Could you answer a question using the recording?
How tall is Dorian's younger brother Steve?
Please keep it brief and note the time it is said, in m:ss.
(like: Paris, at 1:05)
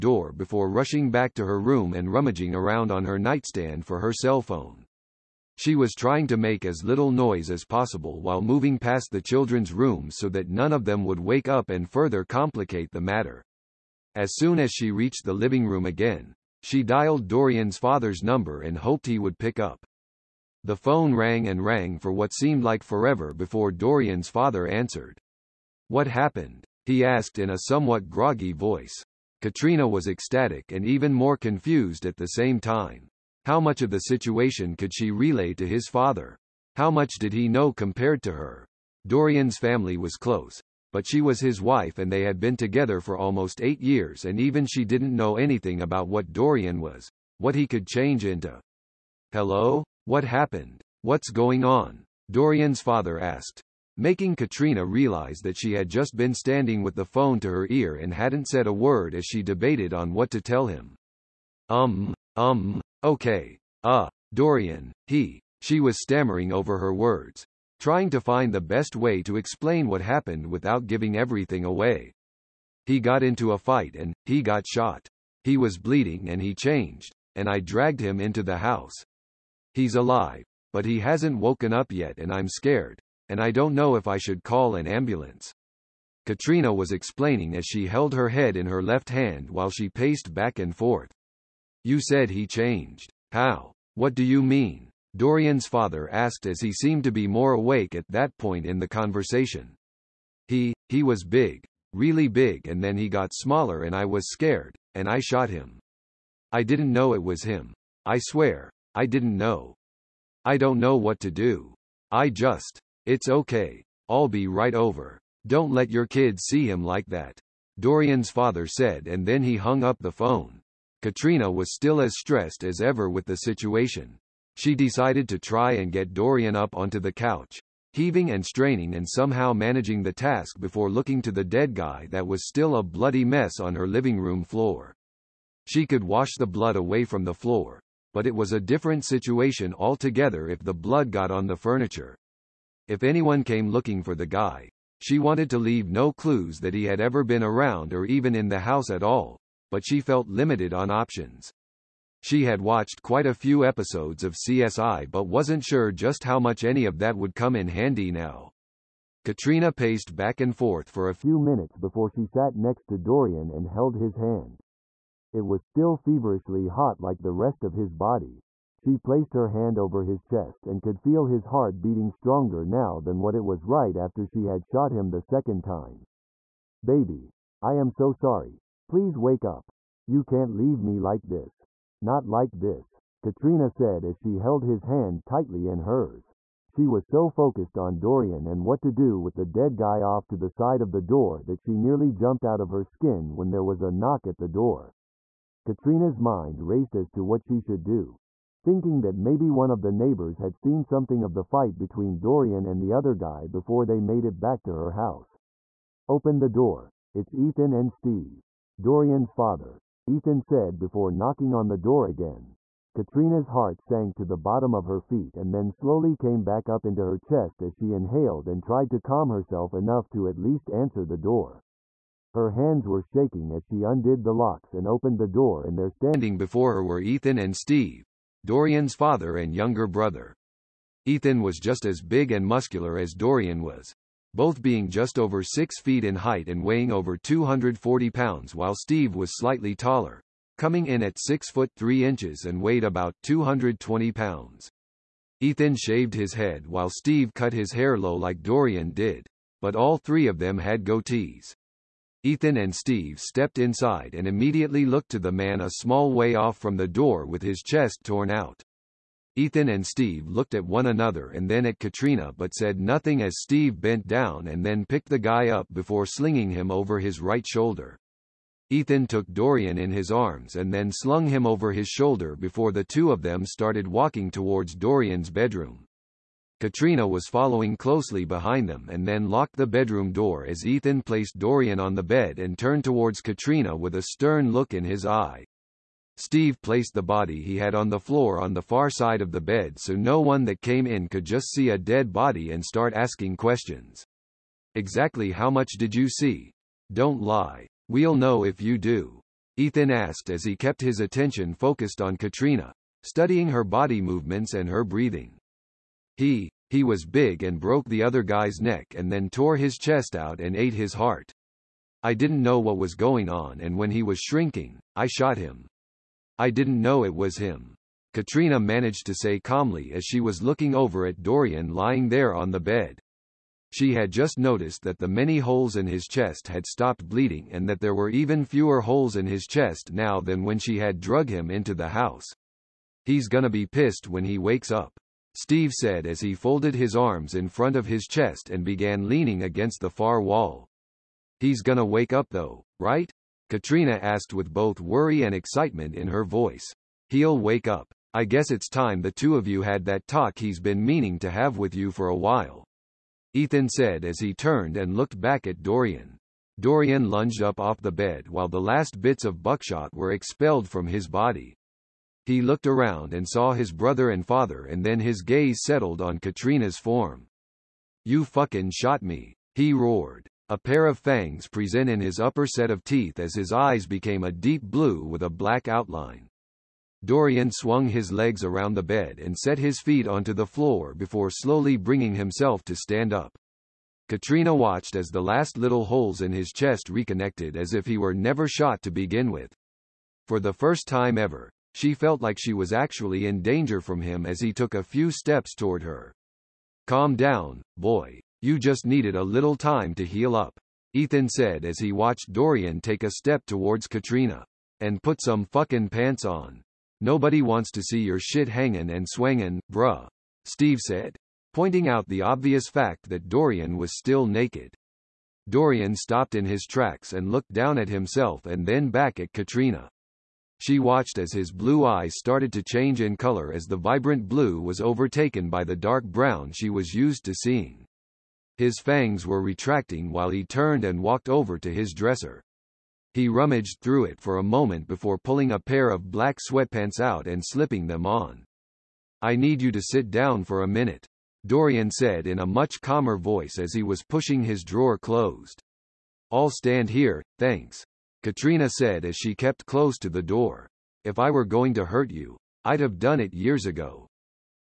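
6 foot 3 inches, at 4:01.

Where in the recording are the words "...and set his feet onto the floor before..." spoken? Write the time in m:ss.
6:19.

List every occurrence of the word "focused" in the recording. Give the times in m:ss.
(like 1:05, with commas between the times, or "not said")
3:07, 5:01.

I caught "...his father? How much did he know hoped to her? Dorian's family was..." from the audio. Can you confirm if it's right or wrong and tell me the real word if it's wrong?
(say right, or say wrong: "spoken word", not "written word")
wrong: "compared", not "hoped".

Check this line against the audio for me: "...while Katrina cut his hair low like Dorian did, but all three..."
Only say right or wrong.
wrong.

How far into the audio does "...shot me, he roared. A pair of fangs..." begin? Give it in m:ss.
6:08.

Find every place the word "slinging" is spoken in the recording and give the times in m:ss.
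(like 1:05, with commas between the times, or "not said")
4:26.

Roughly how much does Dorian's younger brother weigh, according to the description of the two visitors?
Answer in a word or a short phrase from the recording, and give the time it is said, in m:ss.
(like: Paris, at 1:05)
220 pounds, at 4:03.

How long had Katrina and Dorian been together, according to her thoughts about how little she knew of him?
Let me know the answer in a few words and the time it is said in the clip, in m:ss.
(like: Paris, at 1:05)
Almost 8 years, at 0:43.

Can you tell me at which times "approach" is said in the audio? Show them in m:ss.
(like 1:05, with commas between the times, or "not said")
not said.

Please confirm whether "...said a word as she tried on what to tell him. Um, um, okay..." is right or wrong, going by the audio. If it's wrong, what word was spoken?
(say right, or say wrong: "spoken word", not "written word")
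wrong: "debated", not "tried".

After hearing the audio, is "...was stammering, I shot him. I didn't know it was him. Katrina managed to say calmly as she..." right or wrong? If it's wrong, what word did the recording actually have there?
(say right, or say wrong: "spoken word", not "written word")
wrong: "shrinking", not "stammering".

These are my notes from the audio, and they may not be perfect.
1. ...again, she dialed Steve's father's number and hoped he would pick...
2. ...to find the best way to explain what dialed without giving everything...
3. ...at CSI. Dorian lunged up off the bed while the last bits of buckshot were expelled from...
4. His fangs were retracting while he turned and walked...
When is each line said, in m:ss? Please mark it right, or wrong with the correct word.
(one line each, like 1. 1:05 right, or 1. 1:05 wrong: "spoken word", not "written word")
1. 0:15 wrong: "Dorian", not "Steve"
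2. 1:08 wrong: "happened", not "dialed"
3. 5:55 wrong: "Dorian", not "CSI"
4. 7:08 right.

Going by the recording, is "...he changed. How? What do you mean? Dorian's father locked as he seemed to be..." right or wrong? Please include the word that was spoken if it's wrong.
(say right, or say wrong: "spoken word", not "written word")
wrong: "asked", not "locked".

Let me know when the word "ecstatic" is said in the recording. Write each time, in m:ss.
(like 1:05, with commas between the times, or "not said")
0:30.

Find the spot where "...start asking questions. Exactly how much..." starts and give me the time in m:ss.
4:52.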